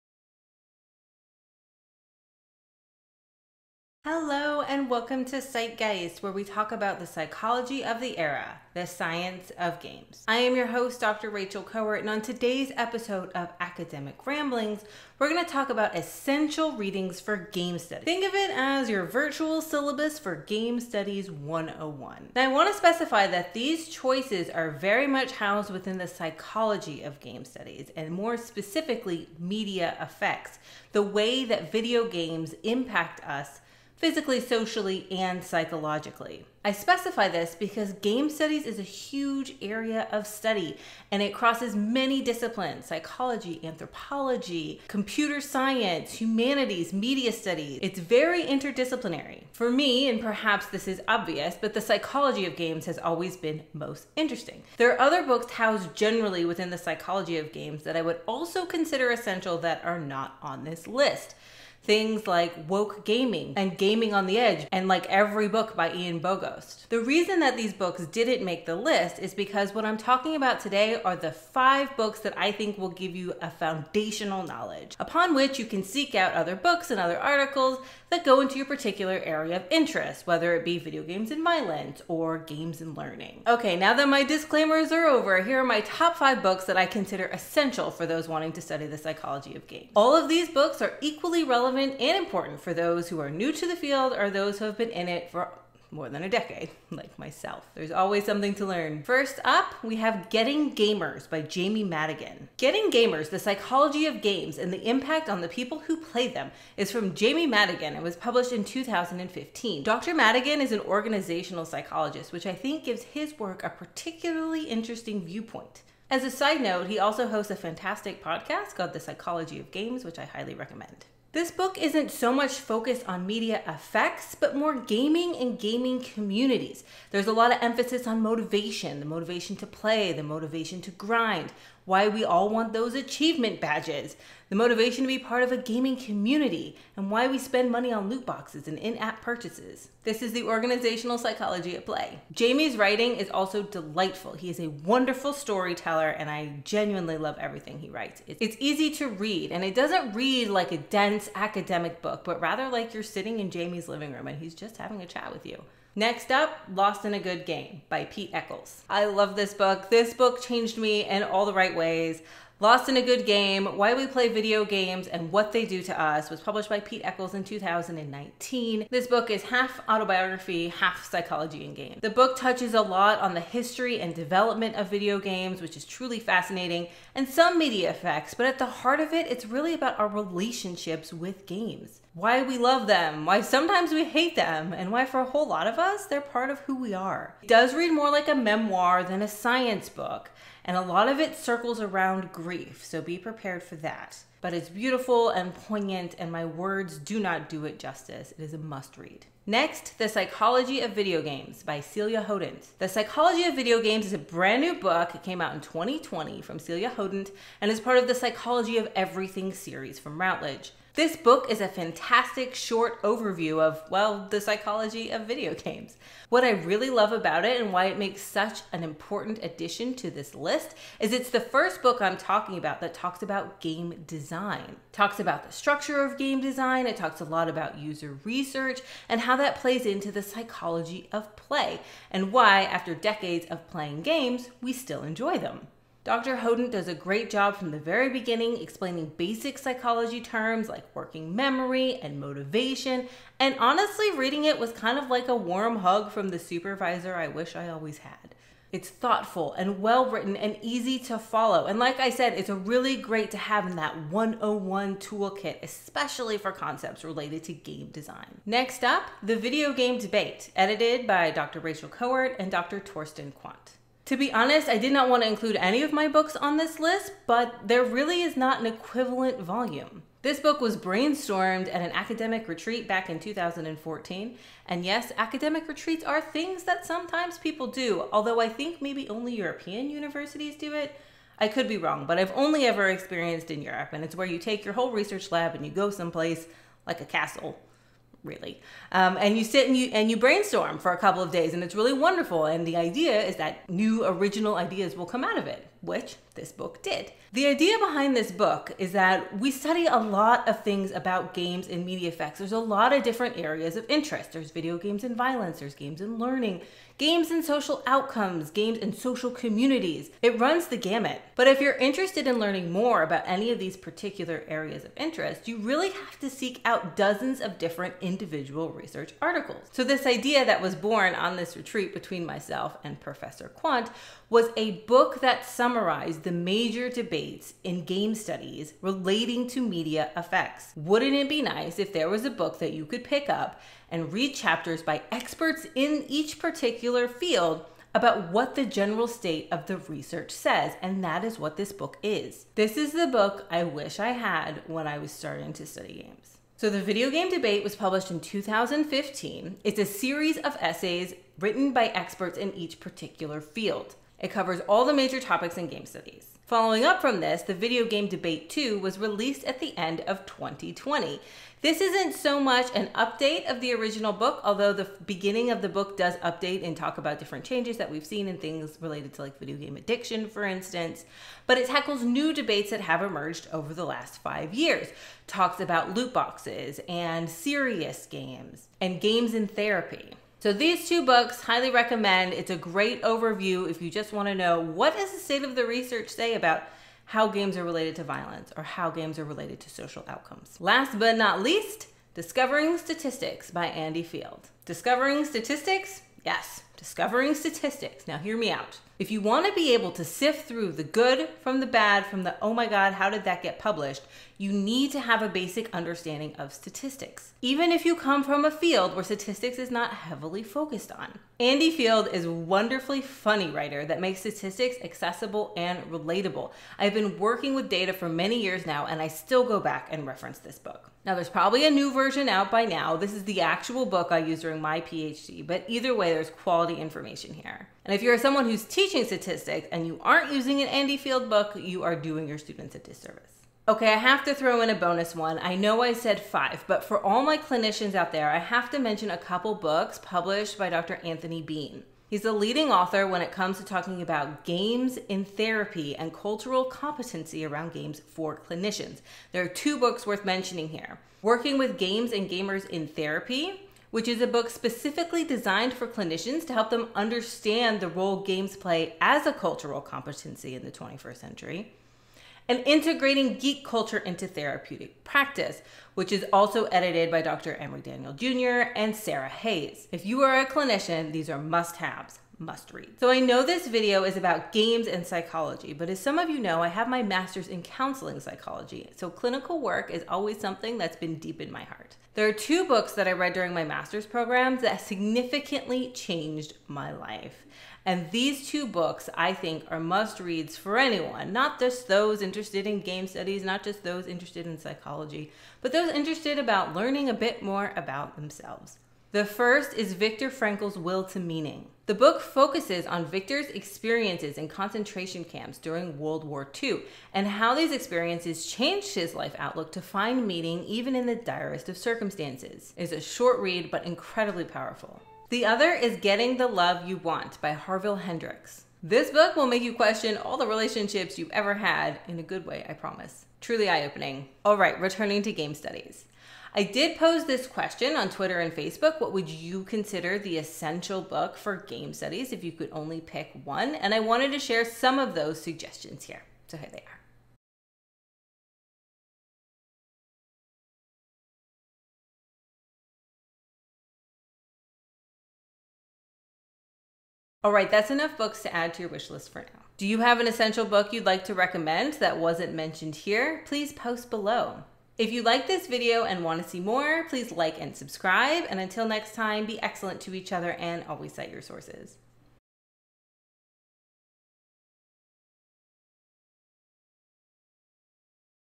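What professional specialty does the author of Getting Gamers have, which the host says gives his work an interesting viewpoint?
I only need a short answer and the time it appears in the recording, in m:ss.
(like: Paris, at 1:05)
Organizational psychologist, at 1:50.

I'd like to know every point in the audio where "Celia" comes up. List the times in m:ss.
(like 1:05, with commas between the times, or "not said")
3:21, 3:26.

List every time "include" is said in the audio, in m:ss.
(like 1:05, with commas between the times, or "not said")
4:25.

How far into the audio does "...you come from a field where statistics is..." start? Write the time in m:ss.
6:47.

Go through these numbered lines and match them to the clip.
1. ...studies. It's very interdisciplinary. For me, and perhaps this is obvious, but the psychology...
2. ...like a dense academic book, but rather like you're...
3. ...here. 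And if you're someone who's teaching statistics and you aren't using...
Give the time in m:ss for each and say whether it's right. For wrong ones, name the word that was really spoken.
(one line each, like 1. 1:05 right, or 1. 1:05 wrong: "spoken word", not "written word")
1. 0:47 right
2. 2:30 right
3. 7:07 right.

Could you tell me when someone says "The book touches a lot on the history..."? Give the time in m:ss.
2:52.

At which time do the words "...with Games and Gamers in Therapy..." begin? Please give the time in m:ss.
7:31.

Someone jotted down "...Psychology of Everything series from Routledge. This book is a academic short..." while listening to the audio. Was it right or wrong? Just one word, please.
wrong.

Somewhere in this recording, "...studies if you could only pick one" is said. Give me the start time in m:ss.
8:51.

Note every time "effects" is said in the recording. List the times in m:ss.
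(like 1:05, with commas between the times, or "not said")
0:30, 2:03, 2:57, 5:02, 5:30.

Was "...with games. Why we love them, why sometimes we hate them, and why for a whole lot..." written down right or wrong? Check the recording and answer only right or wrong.
right.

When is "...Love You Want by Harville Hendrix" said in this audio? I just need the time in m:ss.
8:36.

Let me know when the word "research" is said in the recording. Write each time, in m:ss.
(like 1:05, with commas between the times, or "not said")
3:48, 4:44, 5:18, 5:39, 6:25.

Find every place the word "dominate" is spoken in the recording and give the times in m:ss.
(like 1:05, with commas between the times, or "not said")
not said.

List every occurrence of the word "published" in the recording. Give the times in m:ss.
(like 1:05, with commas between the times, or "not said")
1:48, 2:46, 5:47, 6:43, 7:20.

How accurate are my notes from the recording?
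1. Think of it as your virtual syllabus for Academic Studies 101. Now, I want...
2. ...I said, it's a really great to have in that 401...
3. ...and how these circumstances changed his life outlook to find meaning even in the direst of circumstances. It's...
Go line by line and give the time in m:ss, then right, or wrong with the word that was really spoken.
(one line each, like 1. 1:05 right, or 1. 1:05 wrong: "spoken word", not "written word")
1. 0:18 wrong: "Game", not "Academic"
2. 4:11 wrong: "101", not "401"
3. 8:27 wrong: "experiences", not "circumstances".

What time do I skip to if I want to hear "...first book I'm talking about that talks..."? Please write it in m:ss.
3:41.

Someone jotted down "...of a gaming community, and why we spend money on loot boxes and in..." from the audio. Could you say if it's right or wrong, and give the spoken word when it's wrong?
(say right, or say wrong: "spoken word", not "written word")
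right.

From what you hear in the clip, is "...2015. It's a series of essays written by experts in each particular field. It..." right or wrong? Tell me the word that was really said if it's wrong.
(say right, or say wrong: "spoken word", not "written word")
right.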